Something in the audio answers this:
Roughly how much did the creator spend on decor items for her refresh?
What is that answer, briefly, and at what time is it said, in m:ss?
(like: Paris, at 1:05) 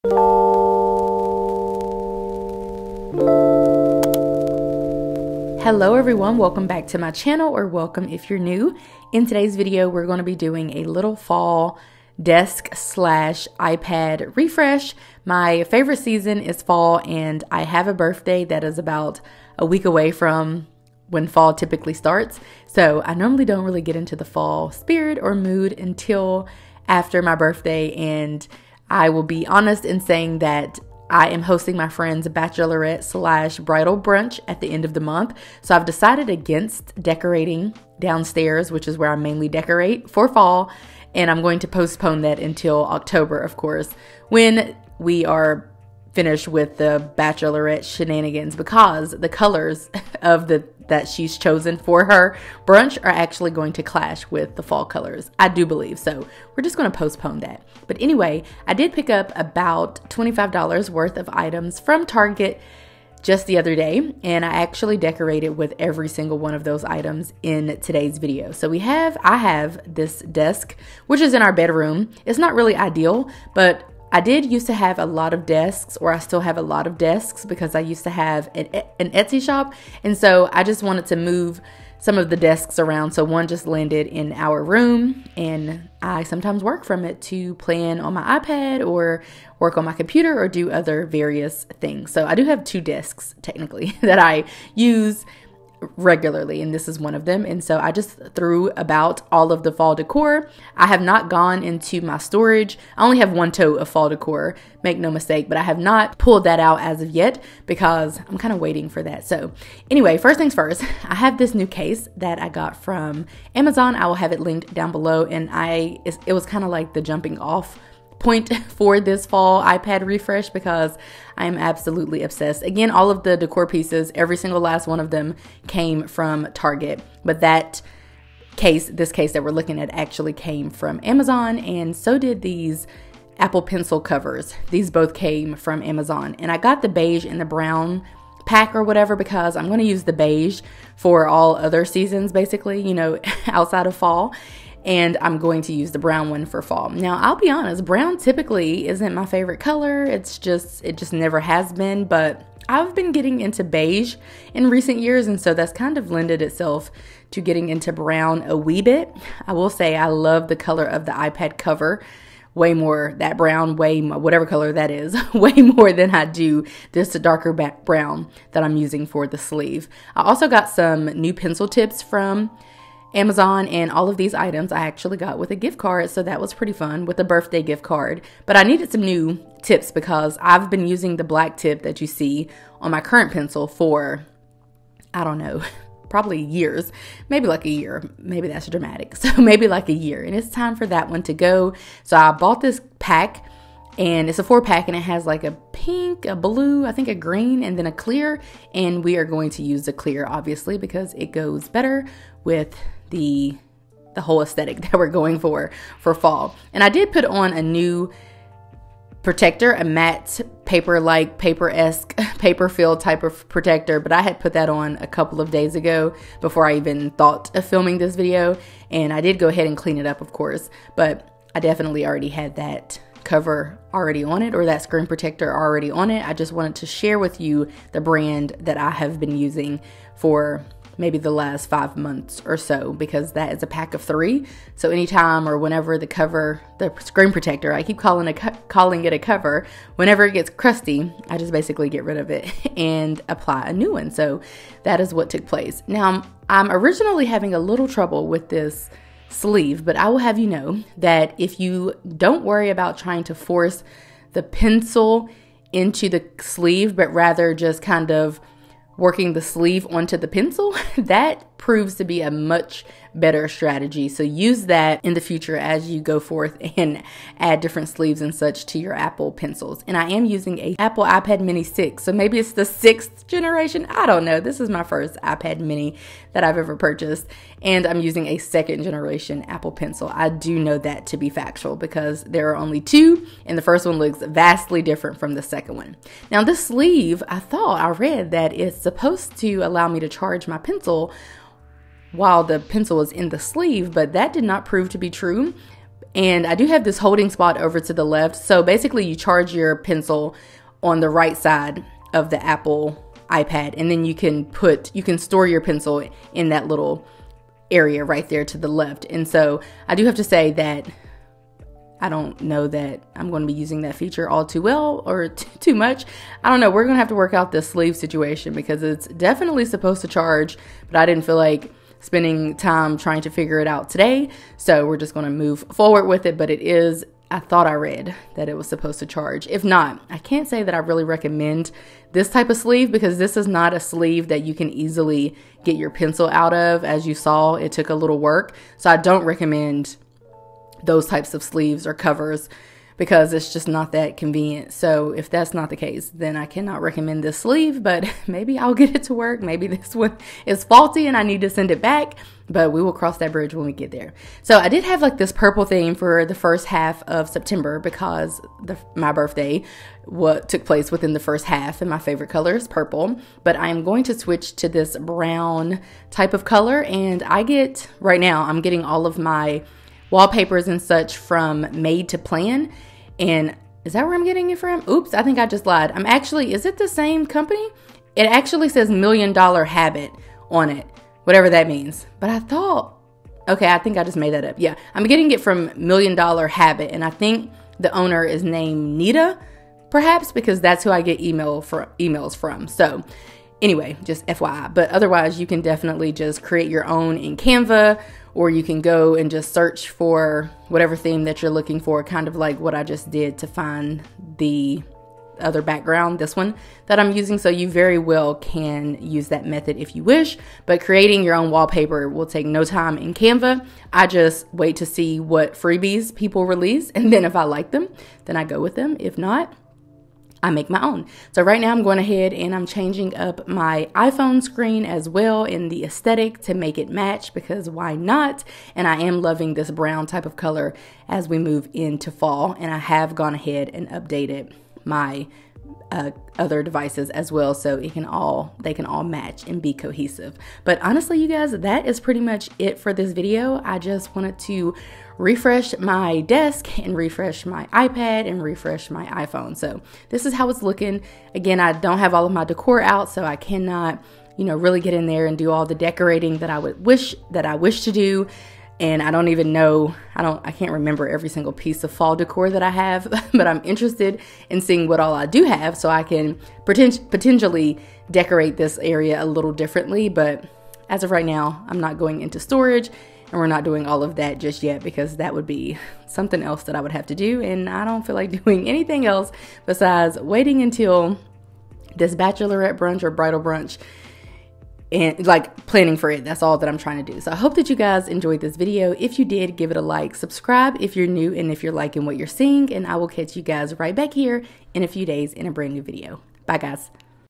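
$25, at 1:00.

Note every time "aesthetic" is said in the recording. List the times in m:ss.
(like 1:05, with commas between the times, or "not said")
3:24, 7:05.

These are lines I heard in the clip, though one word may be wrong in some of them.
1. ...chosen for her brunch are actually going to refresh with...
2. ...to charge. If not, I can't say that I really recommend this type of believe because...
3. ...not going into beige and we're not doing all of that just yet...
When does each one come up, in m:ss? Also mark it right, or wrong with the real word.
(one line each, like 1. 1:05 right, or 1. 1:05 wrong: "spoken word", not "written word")
1. 0:51 wrong: "clash", not "refresh"
2. 5:28 wrong: "sleeve", not "believe"
3. 7:51 wrong: "storage", not "beige".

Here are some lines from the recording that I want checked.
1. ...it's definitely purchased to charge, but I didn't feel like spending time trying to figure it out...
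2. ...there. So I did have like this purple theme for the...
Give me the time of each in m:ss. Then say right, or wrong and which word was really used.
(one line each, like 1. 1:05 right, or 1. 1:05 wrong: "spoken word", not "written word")
1. 5:18 wrong: "supposed", not "purchased"
2. 5:53 right.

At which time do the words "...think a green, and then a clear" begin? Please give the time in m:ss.
3:16.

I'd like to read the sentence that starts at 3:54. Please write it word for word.
So anytime or whenever the cover, the screen protector, I keep calling a calling it a cover.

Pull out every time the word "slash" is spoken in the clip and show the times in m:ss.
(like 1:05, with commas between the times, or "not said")
0:12, 0:33.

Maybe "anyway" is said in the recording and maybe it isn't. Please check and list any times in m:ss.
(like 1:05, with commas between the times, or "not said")
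0:58, 1:49, 6:33.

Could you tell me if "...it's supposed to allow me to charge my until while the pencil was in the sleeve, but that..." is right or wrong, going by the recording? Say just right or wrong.
wrong.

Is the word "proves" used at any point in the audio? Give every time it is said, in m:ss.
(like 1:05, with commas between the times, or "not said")
4:21, 4:54.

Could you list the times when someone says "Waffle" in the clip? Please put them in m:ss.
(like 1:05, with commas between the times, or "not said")
not said.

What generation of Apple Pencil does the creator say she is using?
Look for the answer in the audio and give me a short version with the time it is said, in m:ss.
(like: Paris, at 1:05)
second generation, at 4:38.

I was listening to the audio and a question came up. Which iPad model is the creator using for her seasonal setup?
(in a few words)
iPad mini 6.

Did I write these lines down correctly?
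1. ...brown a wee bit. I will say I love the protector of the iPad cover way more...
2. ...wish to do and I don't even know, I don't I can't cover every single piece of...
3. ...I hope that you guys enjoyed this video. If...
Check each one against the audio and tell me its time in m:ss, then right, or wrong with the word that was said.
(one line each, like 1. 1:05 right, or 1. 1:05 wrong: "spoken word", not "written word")
1. 2:37 wrong: "color", not "protector"
2. 7:37 wrong: "remember", not "cover"
3. 8:07 right.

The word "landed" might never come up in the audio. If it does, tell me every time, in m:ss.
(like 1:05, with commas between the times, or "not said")
1:23.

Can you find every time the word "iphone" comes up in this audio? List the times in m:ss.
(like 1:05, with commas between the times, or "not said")
7:03, 7:29.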